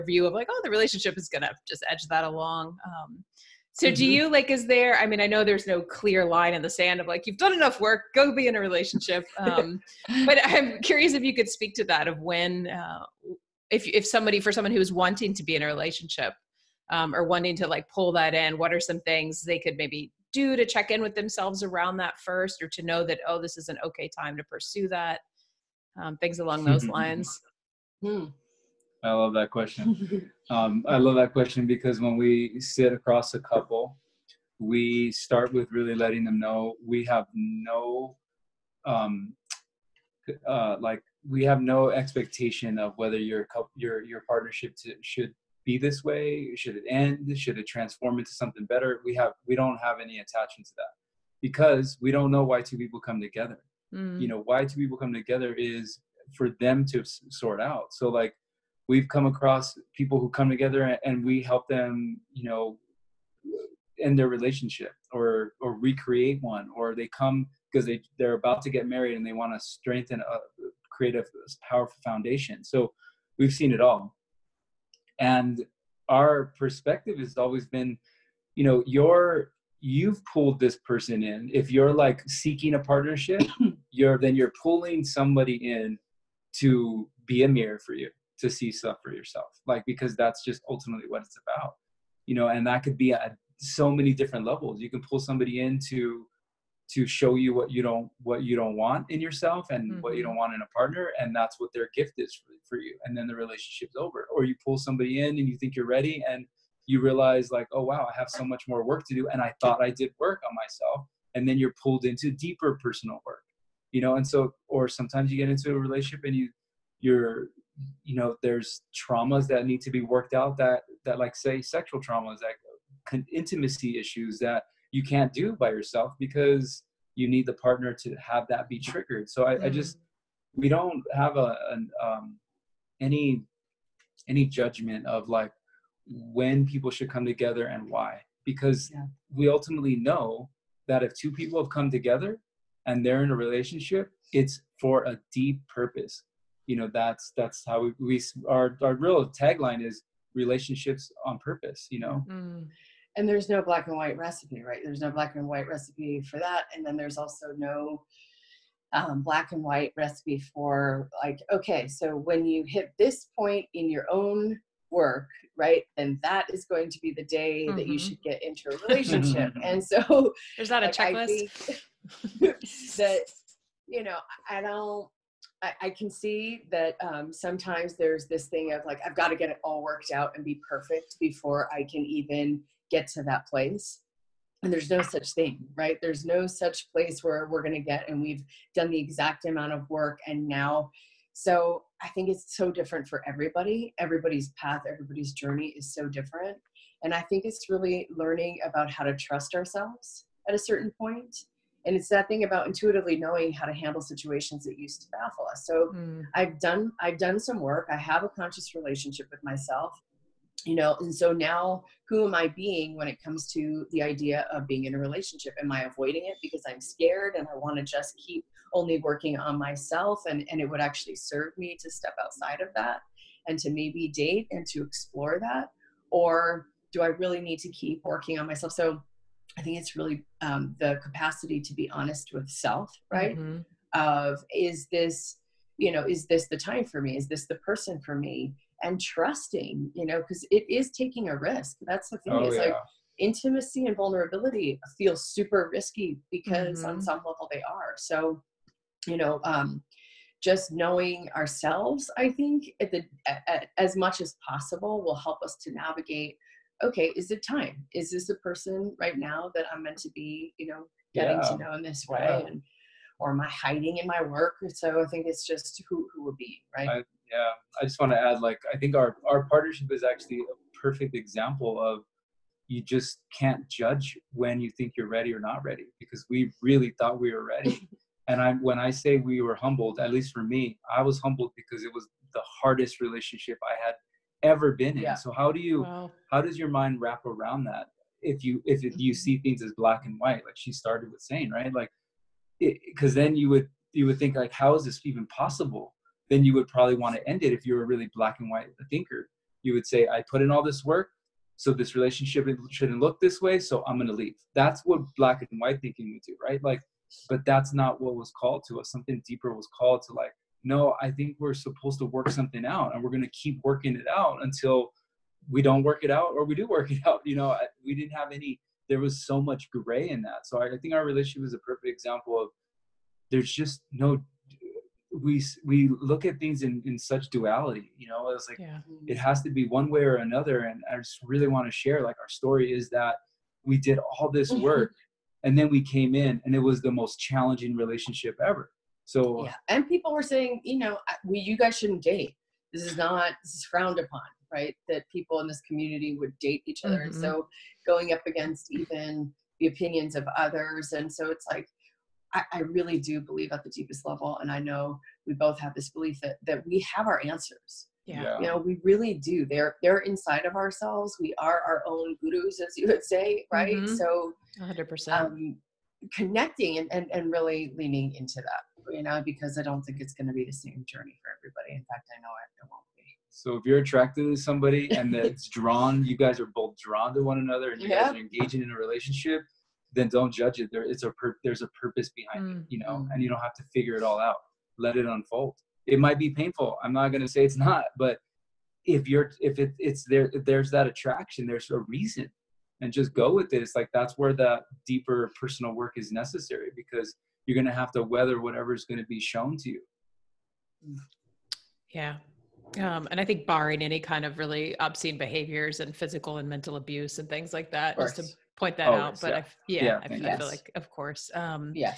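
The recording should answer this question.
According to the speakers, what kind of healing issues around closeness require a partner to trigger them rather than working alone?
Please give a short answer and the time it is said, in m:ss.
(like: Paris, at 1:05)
Sexual traumas, at 2:01.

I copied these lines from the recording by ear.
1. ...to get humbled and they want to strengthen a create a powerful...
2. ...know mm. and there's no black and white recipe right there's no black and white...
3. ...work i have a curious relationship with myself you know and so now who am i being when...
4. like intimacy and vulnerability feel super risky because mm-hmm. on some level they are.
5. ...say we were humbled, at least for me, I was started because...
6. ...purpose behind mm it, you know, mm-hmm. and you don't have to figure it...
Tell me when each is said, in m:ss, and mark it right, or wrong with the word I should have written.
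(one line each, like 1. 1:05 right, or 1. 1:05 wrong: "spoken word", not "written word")
1. 1:08 wrong: "married", not "humbled"
2. 2:31 right
3. 3:27 wrong: "conscious", not "curious"
4. 4:02 right
5. 4:38 wrong: "humbled", not "started"
6. 6:21 right.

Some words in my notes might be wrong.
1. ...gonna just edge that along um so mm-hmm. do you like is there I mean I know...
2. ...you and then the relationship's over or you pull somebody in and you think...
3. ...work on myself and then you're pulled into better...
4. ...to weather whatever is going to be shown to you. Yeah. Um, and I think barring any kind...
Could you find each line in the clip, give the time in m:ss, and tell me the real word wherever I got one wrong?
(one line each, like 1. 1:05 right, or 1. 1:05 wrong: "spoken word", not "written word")
1. 0:01 right
2. 1:42 right
3. 1:50 wrong: "deeper", not "better"
4. 6:37 right.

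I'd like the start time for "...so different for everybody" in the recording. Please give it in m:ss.
3:12.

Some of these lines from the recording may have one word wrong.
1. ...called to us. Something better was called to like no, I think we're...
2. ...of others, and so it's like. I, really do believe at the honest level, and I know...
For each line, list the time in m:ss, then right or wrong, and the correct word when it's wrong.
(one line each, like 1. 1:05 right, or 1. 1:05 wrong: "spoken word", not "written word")
1. 5:08 wrong: "deeper", not "better"
2. 5:50 wrong: "deepest", not "honest".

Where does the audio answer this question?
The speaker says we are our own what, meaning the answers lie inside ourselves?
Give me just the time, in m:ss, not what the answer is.
6:02.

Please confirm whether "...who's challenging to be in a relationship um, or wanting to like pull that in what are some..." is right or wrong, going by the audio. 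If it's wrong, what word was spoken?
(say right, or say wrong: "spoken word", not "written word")
wrong: "wanting", not "challenging".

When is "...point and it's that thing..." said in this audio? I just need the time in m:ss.
3:20.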